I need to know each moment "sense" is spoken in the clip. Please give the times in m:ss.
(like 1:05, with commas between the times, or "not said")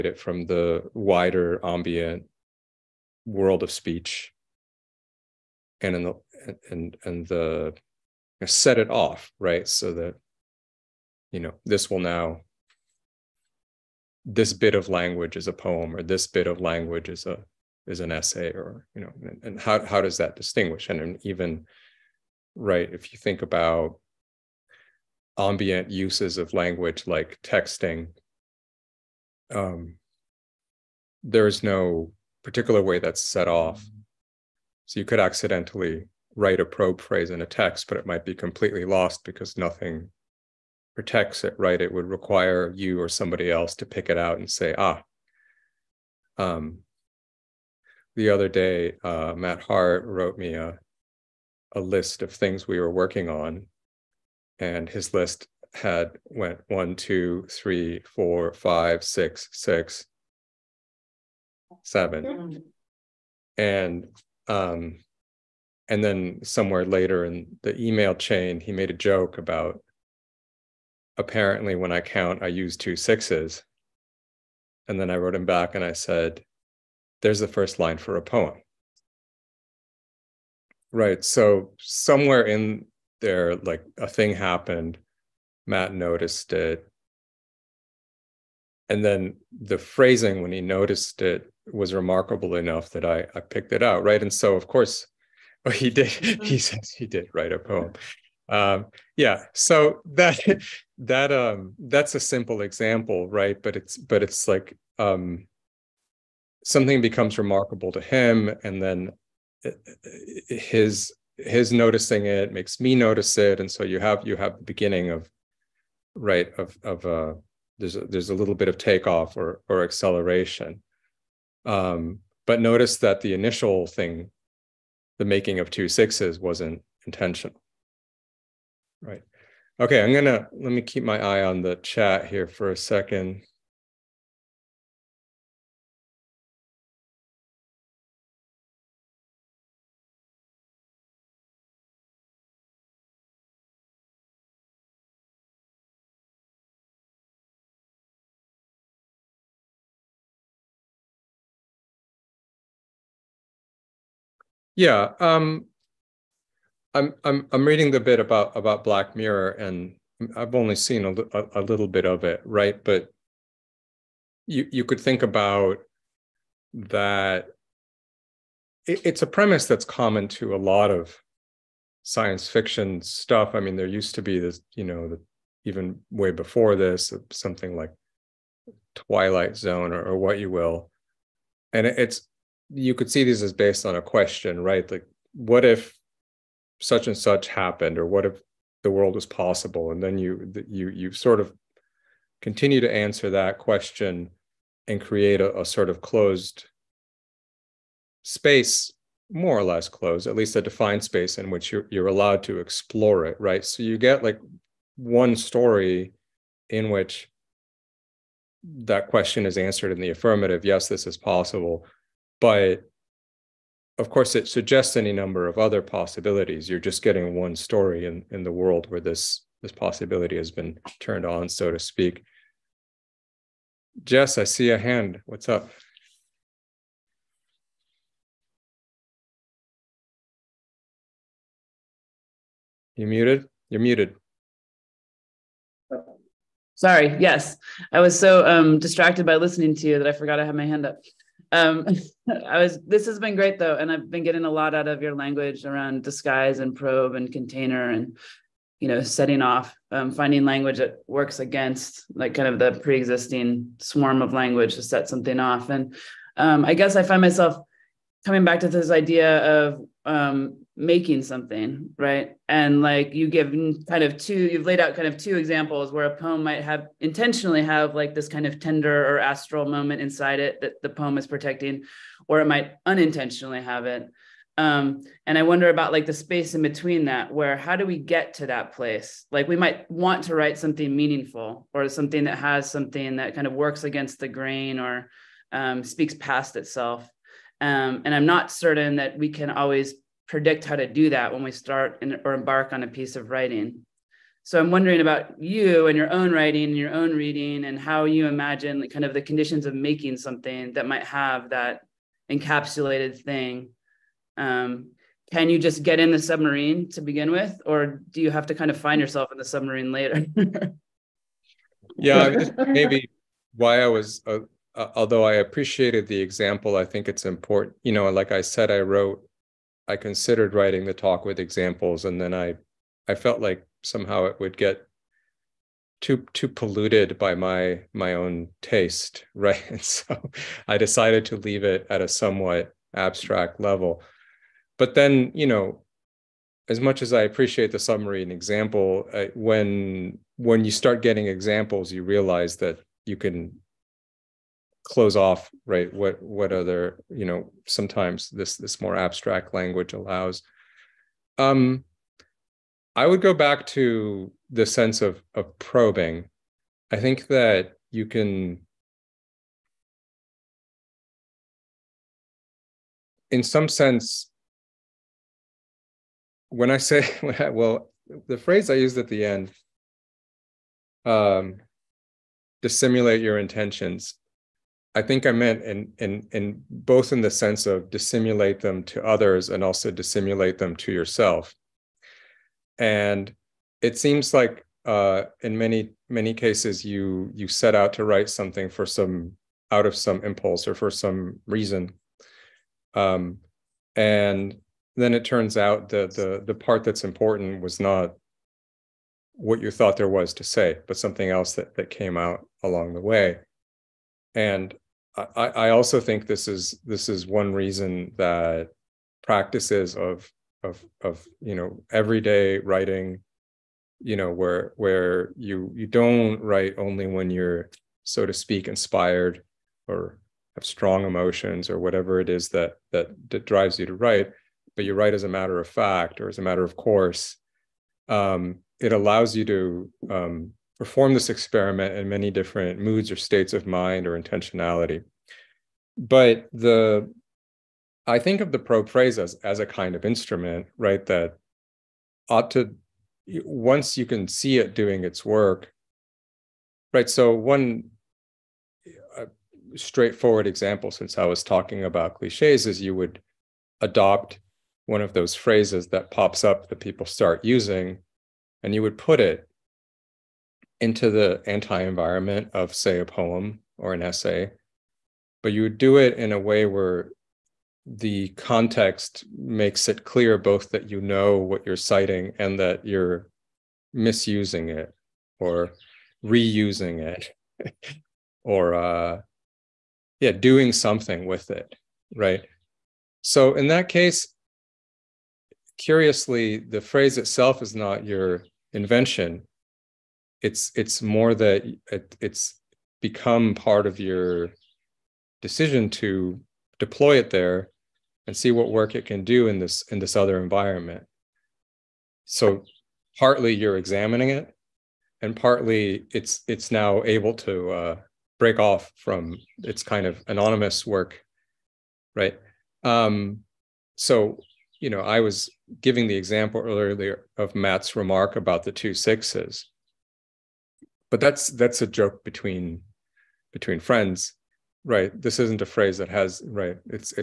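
5:54, 6:03, 6:17.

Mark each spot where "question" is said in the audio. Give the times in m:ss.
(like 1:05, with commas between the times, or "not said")
3:04, 3:13, 3:29.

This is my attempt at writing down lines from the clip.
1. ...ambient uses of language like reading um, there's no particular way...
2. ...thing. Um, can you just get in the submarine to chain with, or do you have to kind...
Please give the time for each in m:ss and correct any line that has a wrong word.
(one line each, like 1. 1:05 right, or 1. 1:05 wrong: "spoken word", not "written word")
1. 0:25 wrong: "texting", not "reading"
2. 5:03 wrong: "begin", not "chain".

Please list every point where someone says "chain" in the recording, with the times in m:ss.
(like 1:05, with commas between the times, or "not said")
1:08.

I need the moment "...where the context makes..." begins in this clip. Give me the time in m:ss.
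7:46.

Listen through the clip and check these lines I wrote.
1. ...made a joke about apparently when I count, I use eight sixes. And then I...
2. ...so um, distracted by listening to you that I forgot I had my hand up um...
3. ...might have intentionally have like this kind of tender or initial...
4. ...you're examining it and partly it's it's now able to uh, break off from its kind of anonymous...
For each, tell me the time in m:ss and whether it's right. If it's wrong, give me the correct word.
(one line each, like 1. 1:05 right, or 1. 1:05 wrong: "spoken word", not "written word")
1. 1:08 wrong: "two", not "eight"
2. 3:58 right
3. 4:26 wrong: "astral", not "initial"
4. 8:23 right.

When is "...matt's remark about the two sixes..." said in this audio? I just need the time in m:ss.
8:37.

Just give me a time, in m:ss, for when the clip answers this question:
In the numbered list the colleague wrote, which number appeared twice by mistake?
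0:59.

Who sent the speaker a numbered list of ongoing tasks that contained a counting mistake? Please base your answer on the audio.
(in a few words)
Matt Hart.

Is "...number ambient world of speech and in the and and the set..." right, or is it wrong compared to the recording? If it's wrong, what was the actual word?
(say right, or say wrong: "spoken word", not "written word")
wrong: "wider", not "number".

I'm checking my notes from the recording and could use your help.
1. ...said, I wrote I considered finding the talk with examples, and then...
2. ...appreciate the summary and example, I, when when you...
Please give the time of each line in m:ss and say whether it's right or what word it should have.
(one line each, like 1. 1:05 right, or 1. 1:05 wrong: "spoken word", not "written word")
1. 5:18 wrong: "writing", not "finding"
2. 5:37 right.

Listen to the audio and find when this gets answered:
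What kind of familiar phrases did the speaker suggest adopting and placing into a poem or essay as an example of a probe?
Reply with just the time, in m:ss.
7:32.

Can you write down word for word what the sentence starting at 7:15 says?
But the I think of the probe phrase as, as a kind of instrument, right?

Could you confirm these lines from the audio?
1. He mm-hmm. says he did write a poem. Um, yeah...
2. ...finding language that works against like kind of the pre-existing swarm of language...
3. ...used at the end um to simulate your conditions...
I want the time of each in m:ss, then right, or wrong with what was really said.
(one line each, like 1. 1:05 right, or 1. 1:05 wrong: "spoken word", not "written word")
1. 1:36 right
2. 4:10 right
3. 6:08 wrong: "intentions", not "conditions".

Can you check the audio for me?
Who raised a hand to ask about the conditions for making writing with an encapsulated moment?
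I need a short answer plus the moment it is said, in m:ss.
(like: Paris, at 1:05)
Jess, at 3:44.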